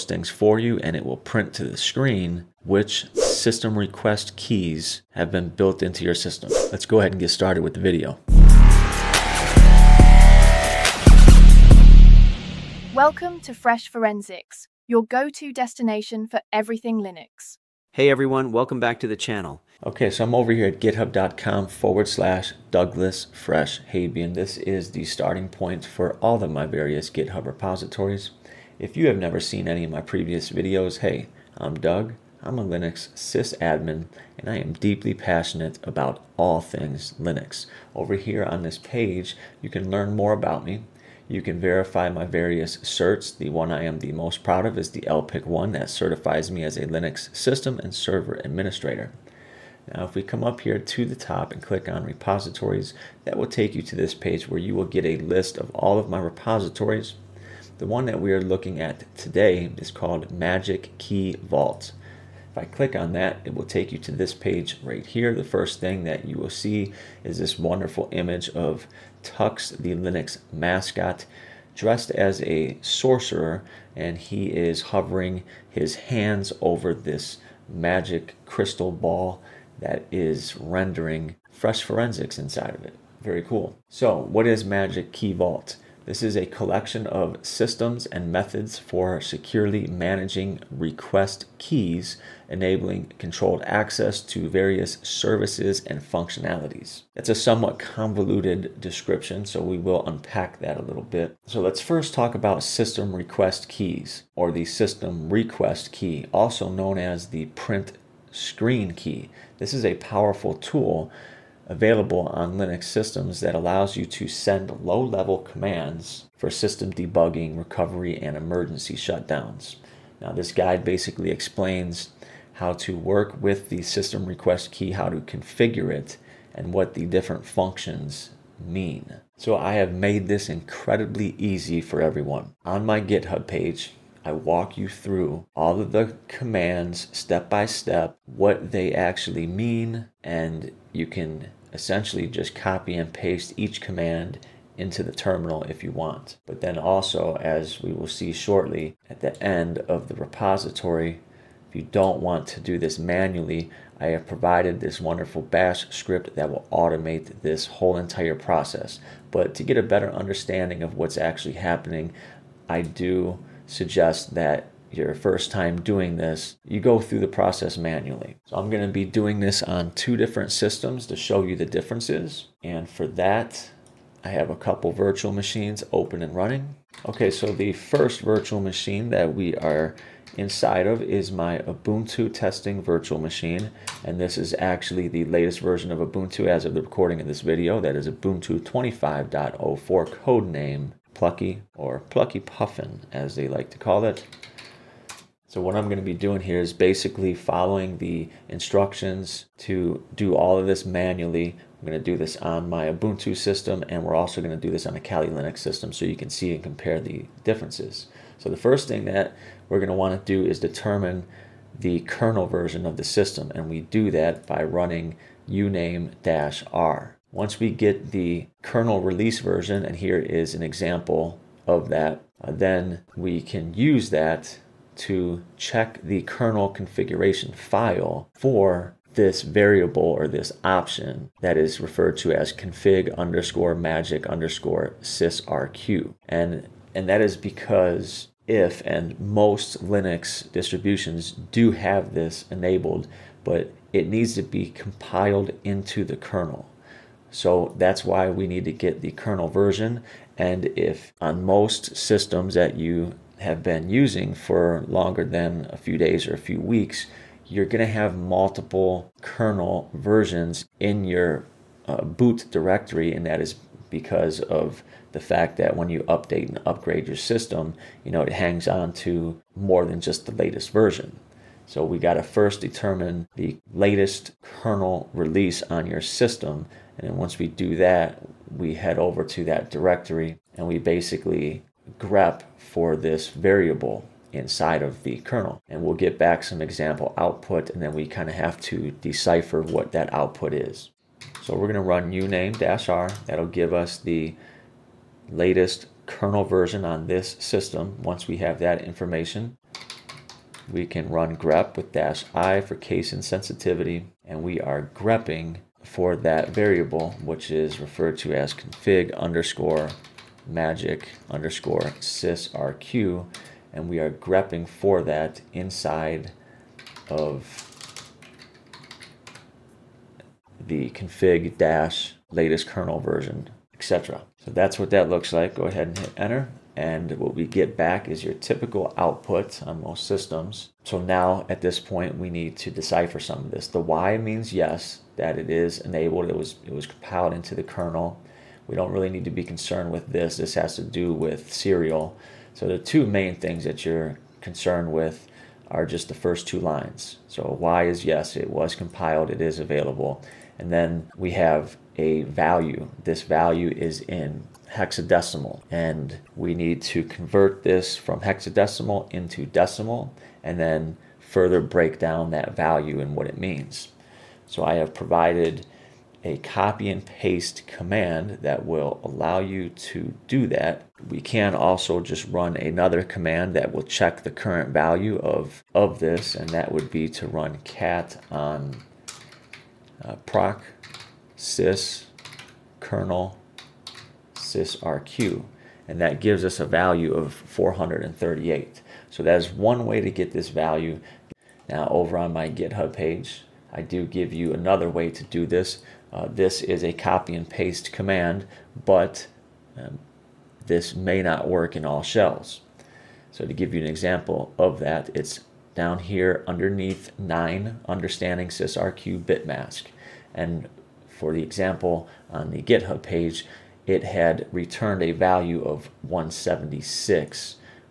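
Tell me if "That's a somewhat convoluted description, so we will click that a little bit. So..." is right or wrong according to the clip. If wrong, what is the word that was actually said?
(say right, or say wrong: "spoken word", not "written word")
wrong: "unpack", not "click".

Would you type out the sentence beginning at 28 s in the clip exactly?
If you have never seen any of my previous videos, hey, I'm Doug.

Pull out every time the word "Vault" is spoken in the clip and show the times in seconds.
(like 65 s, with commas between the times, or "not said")
61 s, 85 s.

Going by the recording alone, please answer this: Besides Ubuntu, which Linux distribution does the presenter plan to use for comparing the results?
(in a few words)
Kali Linux.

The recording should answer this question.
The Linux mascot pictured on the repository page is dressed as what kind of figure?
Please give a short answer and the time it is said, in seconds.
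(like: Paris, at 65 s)
sorcerer, at 72 s.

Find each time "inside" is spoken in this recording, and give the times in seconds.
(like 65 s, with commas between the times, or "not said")
82 s, 180 s, 284 s, 315 s.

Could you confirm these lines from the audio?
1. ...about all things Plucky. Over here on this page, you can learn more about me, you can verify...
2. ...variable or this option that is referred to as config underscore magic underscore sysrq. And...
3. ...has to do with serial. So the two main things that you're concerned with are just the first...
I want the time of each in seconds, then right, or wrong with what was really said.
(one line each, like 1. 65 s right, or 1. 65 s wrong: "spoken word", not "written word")
1. 35 s wrong: "Linux", not "Plucky"
2. 229 s right
3. 340 s right.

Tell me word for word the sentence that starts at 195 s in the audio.
So what I'm going to be doing here is basically following the instructions to do all of this manually.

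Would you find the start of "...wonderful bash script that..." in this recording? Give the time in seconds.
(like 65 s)
155 s.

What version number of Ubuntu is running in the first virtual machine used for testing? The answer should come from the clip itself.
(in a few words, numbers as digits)
25.04.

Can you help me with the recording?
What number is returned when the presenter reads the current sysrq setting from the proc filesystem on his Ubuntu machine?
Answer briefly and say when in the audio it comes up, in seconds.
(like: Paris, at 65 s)
438, at 387 s.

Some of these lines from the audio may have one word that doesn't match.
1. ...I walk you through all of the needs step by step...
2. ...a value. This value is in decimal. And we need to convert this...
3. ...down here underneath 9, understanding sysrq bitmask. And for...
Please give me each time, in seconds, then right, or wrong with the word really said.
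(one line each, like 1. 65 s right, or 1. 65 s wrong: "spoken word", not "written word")
1. 134 s wrong: "commands", not "needs"
2. 351 s wrong: "hexadecimal", not "decimal"
3. 405 s right.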